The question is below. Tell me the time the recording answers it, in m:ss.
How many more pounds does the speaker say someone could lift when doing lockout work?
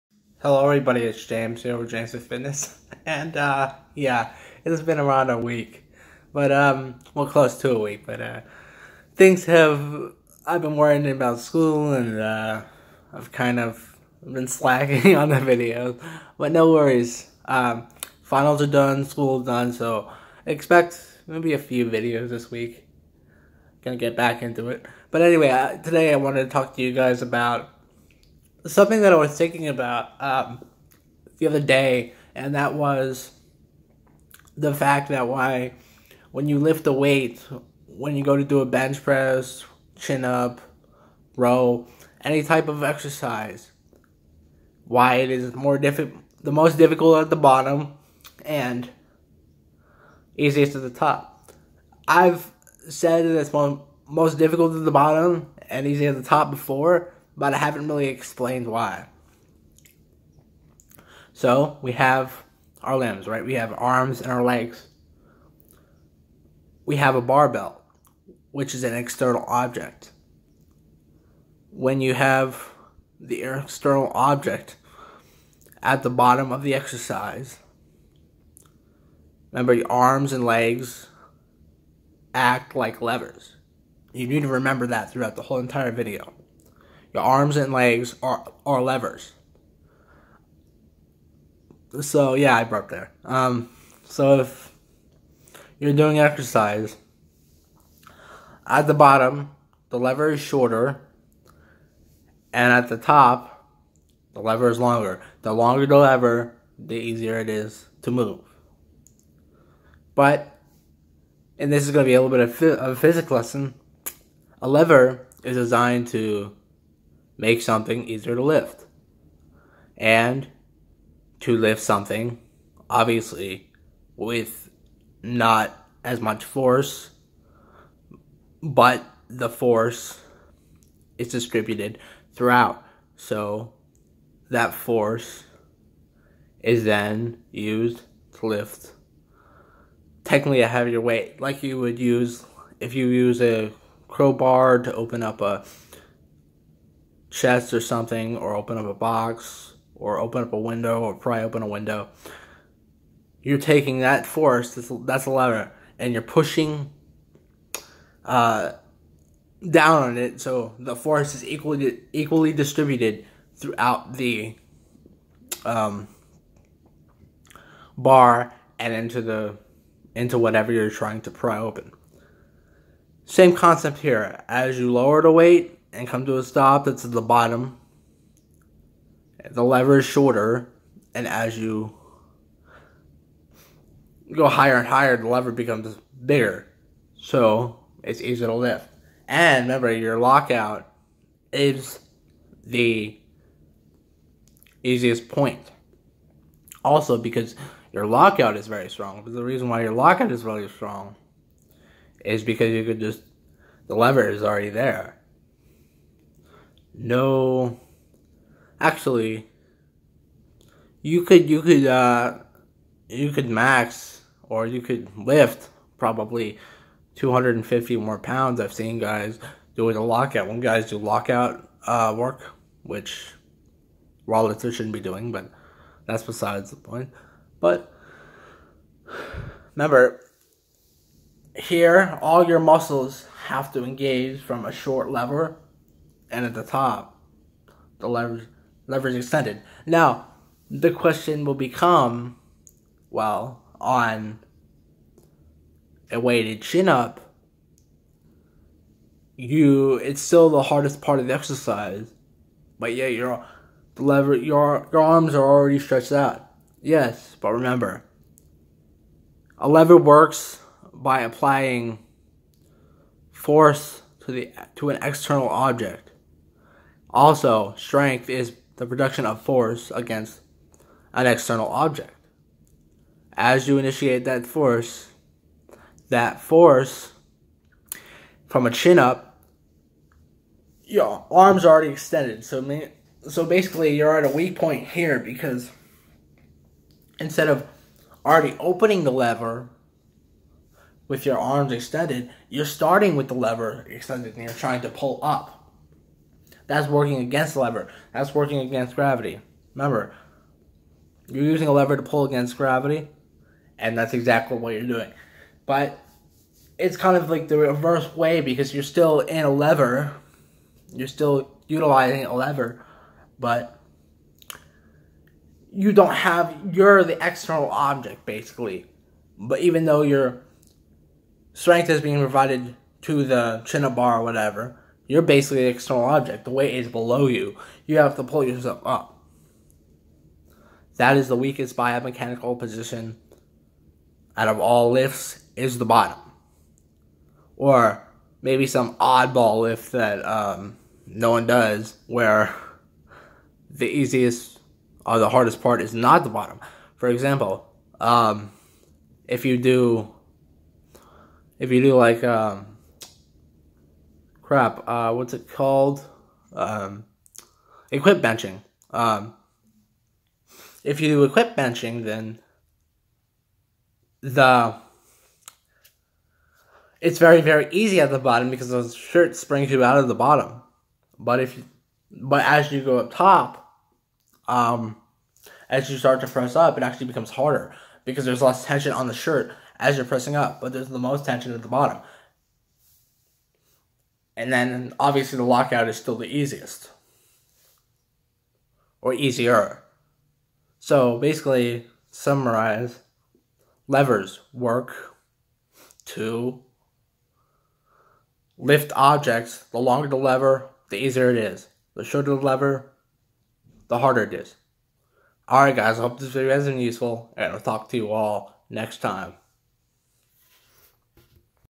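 3:37.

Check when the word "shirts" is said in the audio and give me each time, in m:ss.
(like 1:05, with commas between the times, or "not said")
6:08, 6:19.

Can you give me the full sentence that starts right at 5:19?
But even though your strength is being provided to the chin bar or whatever, you're basically an external object.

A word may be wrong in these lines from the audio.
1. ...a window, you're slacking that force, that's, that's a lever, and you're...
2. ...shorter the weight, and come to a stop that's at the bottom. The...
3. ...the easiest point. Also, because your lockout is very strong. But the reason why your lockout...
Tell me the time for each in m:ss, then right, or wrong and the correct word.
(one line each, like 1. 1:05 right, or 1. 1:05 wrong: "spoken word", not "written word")
1. 2:31 wrong: "taking", not "slacking"
2. 2:54 wrong: "lower", not "shorter"
3. 3:12 right.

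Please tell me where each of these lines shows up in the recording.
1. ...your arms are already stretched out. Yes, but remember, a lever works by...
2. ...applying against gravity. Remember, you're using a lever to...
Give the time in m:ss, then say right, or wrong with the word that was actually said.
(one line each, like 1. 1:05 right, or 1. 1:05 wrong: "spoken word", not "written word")
1. 4:14 right
2. 4:58 wrong: "working", not "applying".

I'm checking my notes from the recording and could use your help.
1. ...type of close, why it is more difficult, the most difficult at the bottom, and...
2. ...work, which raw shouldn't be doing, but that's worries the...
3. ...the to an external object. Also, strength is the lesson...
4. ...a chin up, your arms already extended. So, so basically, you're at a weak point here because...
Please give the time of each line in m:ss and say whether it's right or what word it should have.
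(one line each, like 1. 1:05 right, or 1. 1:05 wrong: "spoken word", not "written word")
1. 0:42 wrong: "exercise", not "close"
2. 3:42 wrong: "besides", not "worries"
3. 4:24 wrong: "production", not "lesson"
4. 4:38 right.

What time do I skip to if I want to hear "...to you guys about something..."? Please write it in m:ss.
0:26.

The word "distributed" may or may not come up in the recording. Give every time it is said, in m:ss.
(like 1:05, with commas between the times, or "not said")
2:11, 2:42.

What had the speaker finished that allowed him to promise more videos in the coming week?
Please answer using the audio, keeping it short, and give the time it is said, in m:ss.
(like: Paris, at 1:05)
Finals, at 0:18.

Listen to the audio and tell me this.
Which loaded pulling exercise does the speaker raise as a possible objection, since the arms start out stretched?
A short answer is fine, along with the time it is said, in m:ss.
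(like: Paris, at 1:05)
Weighted chin up, at 4:06.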